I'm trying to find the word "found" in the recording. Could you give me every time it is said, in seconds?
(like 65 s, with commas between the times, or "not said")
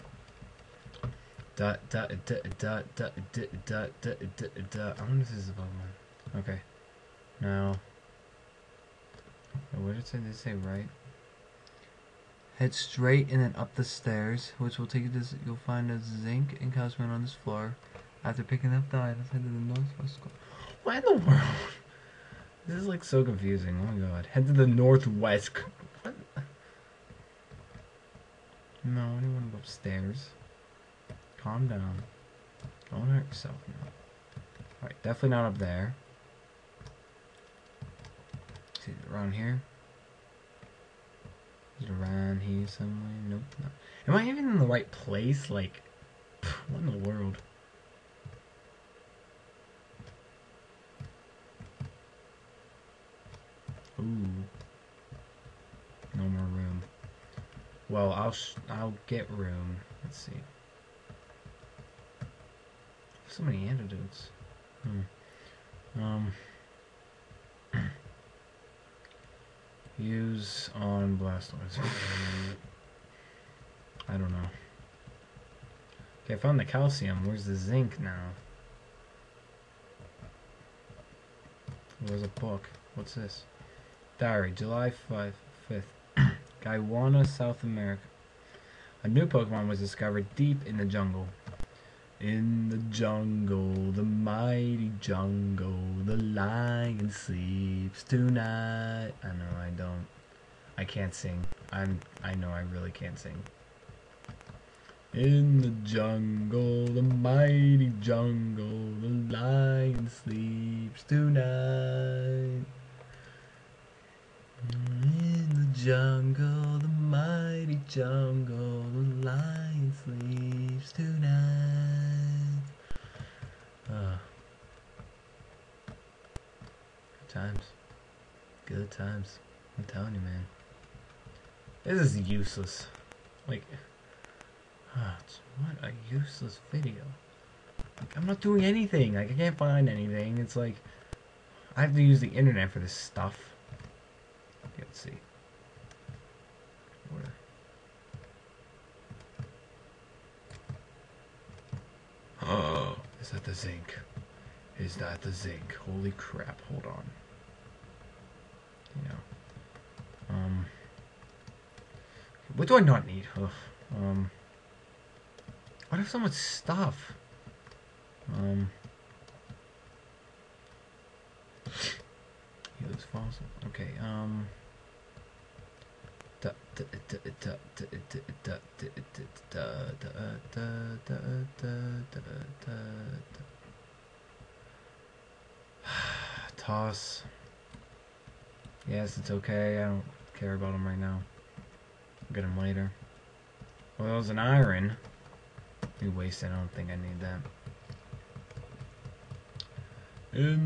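76 s.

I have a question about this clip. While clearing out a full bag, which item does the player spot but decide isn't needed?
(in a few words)
Iron.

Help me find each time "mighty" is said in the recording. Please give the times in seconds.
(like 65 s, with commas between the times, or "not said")
94 s, 107 s, 116 s.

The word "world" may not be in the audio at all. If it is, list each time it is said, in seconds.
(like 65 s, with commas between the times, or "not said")
21 s, 47 s.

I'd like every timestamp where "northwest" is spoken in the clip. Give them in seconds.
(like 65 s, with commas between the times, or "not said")
19 s, 24 s.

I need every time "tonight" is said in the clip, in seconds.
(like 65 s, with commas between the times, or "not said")
98 s, 111 s.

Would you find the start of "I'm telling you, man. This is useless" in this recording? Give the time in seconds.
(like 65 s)
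129 s.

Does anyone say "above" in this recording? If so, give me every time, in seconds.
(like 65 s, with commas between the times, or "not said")
5 s.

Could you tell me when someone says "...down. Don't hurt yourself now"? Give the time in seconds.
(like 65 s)
31 s.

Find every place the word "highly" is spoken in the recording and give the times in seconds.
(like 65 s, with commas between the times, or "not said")
not said.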